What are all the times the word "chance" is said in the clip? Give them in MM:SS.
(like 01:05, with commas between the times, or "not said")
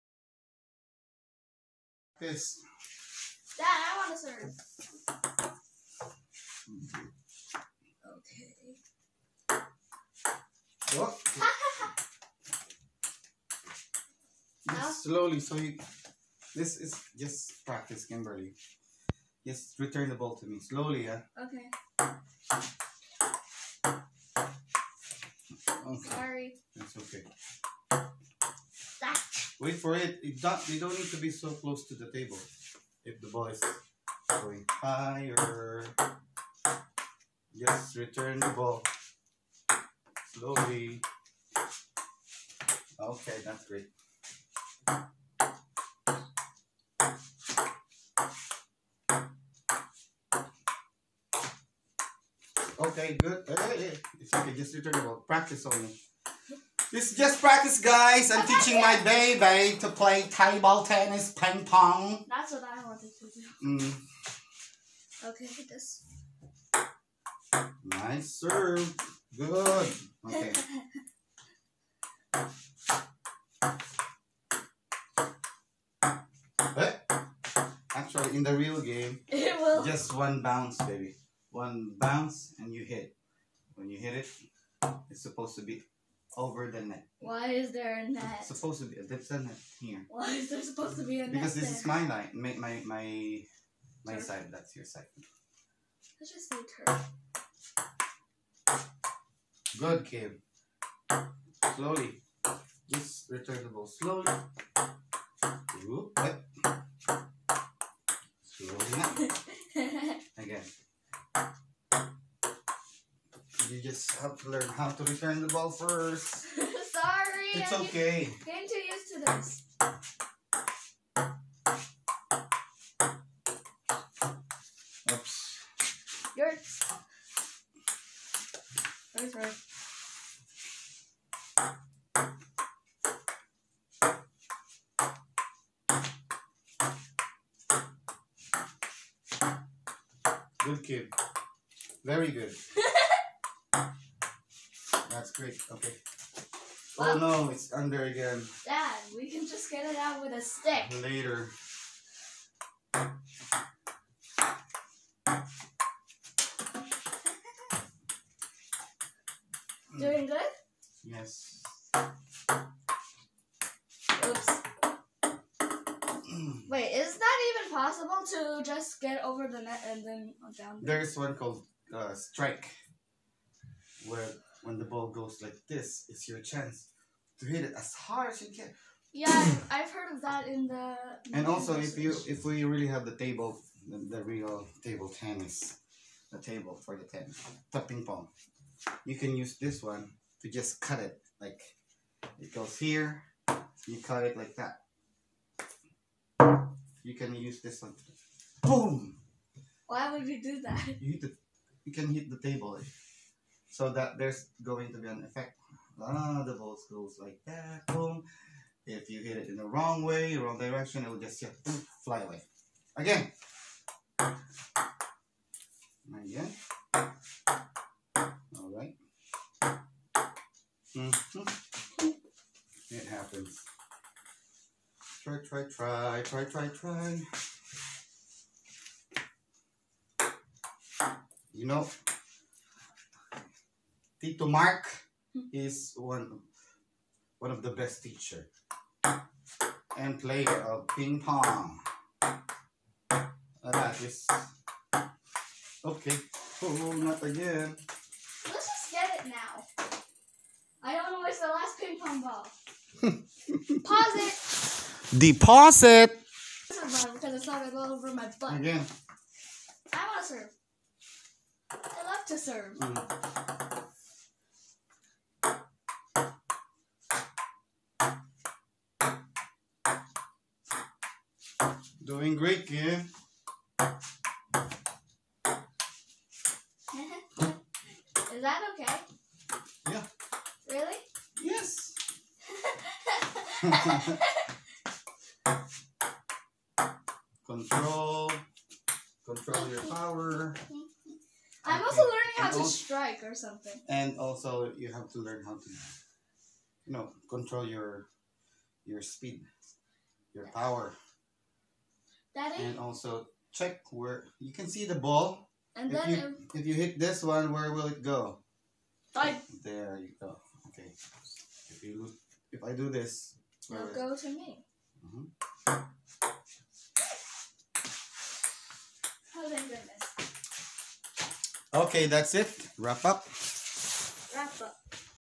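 02:56.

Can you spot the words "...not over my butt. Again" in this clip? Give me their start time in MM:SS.
04:17.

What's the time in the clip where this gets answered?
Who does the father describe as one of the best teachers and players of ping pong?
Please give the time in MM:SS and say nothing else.
03:54.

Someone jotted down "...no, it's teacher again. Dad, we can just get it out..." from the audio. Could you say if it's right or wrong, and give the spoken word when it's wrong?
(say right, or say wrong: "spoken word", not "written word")
wrong: "under", not "teacher".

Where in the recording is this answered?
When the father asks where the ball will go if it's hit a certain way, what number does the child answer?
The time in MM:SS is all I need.
05:09.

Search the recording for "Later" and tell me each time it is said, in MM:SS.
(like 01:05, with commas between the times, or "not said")
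02:31.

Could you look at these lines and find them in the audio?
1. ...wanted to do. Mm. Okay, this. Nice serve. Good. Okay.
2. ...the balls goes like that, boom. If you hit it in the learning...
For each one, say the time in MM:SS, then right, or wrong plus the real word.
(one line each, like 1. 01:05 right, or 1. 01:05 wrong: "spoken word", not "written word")
1. 01:02 right
2. 03:26 wrong: "wrong", not "learning".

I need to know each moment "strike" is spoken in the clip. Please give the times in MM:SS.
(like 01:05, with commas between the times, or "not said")
02:52, 04:52.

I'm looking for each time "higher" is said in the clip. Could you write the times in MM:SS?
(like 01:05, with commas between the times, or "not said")
00:34.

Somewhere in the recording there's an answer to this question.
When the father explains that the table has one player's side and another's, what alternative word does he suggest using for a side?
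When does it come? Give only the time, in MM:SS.
01:36.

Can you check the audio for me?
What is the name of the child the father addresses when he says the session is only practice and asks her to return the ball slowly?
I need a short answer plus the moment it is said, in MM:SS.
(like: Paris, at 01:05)
Kimberly, at 00:18.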